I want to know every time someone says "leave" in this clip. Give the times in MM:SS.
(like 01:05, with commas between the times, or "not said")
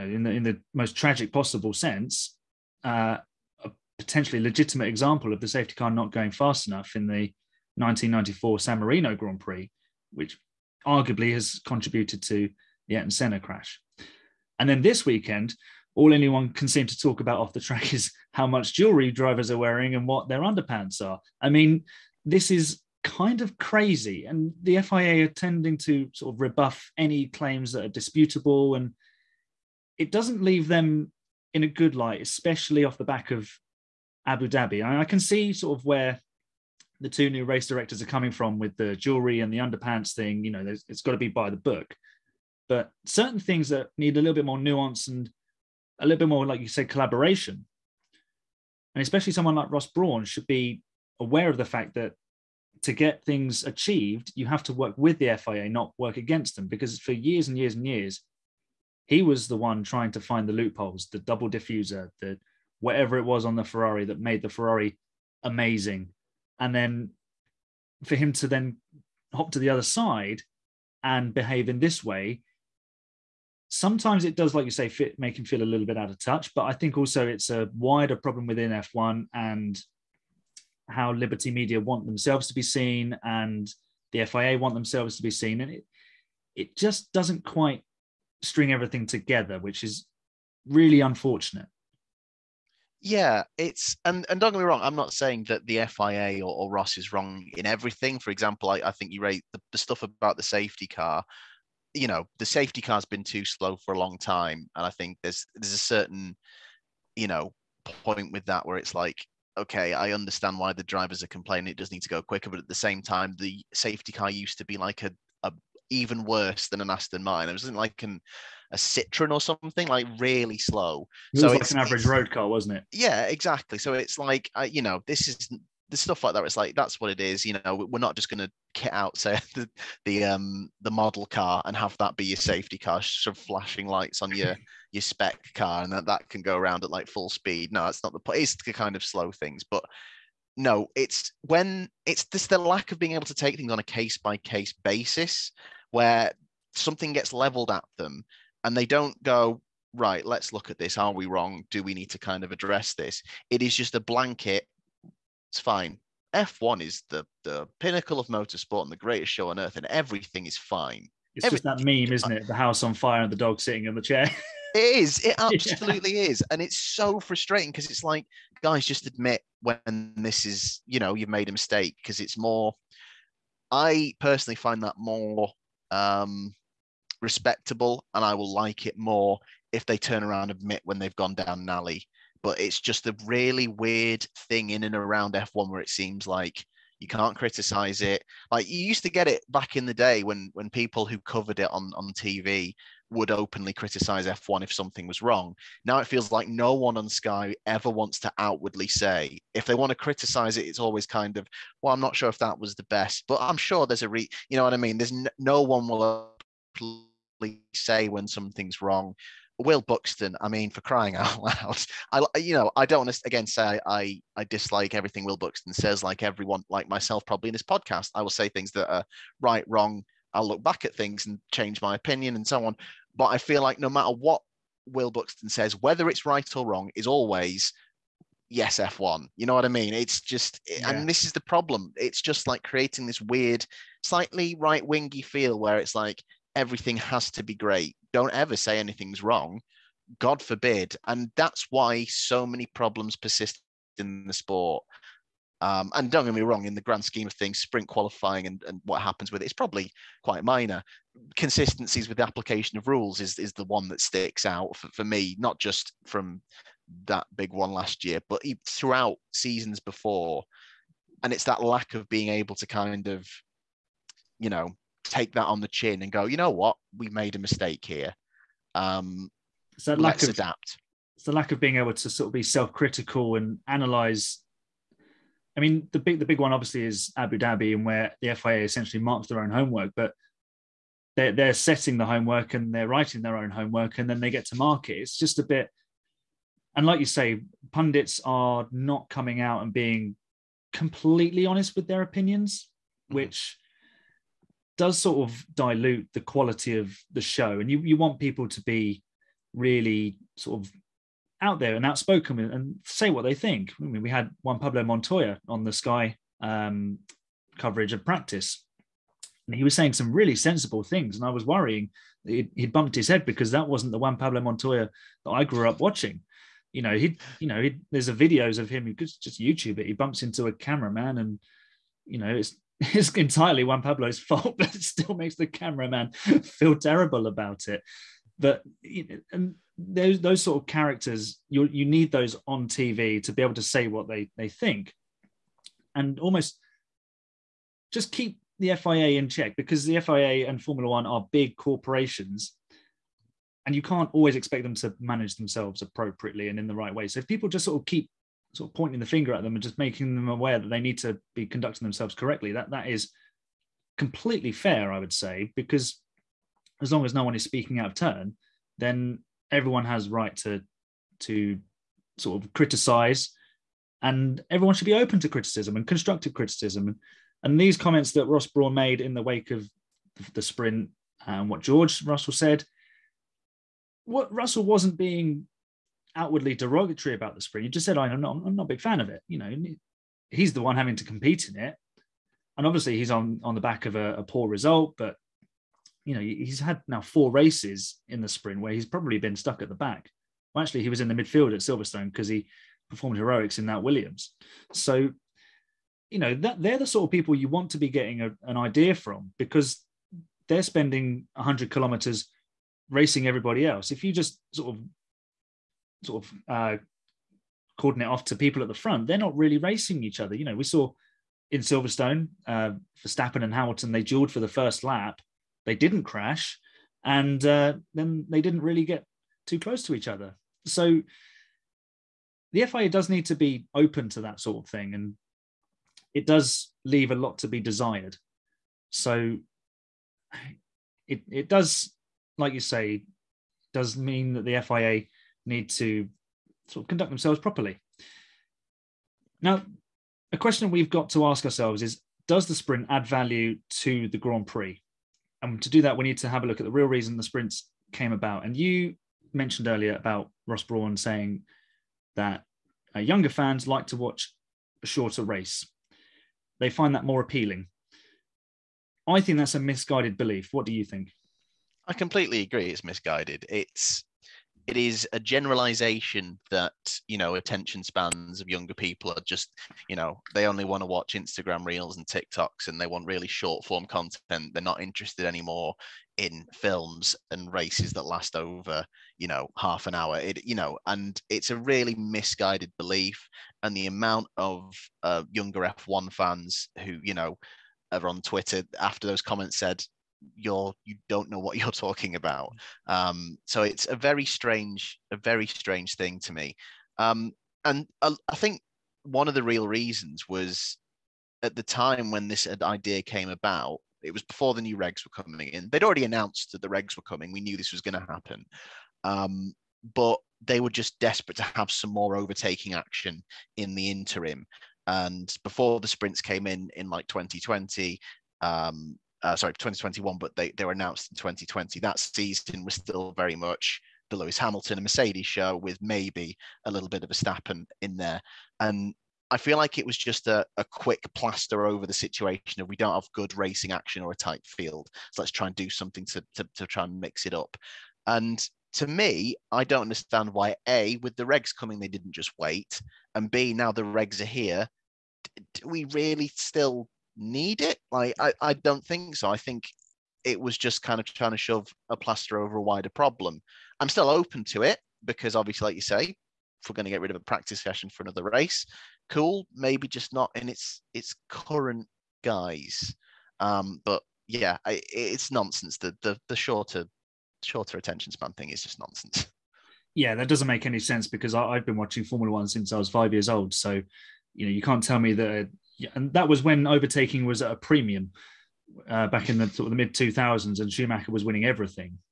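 00:30, 07:06.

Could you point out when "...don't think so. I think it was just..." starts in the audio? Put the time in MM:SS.
09:08.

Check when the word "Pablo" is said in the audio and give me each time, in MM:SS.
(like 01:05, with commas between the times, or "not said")
05:04, 05:14, 05:23.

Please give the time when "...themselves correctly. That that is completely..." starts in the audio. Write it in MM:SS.
05:51.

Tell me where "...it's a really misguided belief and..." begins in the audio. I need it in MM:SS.
08:01.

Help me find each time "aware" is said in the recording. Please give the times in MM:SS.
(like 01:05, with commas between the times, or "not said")
00:51, 05:50.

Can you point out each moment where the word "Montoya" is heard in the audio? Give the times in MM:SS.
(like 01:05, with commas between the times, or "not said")
05:04, 05:14.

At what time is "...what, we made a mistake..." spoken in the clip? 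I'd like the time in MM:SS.
04:26.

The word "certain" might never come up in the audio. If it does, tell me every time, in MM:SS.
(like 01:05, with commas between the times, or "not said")
00:43, 01:45.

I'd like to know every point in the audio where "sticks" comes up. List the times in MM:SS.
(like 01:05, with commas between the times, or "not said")
04:13.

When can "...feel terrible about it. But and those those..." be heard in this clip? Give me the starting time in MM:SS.
05:26.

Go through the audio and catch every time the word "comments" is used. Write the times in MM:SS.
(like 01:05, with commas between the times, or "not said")
06:07, 08:09.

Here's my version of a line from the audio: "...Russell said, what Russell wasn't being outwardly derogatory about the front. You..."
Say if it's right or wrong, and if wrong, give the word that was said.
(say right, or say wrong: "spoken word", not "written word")
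wrong: "sprint", not "front".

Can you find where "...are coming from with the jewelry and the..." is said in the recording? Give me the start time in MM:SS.
00:38.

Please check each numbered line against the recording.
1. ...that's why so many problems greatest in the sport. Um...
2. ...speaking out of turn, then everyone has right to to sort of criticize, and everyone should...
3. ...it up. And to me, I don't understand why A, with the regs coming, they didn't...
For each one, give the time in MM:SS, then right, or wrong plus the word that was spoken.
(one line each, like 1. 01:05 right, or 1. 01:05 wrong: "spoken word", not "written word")
1. 04:01 wrong: "persist", not "greatest"
2. 05:57 right
3. 08:57 right.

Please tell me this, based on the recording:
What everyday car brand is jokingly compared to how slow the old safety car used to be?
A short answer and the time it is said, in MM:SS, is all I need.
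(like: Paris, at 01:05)
Citroen, at 01:58.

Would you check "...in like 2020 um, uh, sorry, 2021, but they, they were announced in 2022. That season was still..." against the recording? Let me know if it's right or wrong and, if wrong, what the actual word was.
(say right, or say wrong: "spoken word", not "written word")
wrong: "2020", not "2022".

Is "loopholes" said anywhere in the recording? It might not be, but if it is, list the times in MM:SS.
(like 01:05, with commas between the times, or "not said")
01:00.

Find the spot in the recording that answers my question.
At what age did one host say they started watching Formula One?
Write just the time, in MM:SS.
09:32.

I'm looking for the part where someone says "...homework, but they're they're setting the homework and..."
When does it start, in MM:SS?
04:39.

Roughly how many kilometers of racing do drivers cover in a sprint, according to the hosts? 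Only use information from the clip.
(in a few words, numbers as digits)
100 kilometers.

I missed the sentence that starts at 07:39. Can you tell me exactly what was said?
I think that's a misguided belief.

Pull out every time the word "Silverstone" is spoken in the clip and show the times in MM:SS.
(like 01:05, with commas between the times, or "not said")
06:31, 06:51.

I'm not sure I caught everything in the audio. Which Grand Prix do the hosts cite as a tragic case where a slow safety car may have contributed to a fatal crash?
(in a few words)
1994 San Marino Grand Prix.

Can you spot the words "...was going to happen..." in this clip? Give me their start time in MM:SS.
08:27.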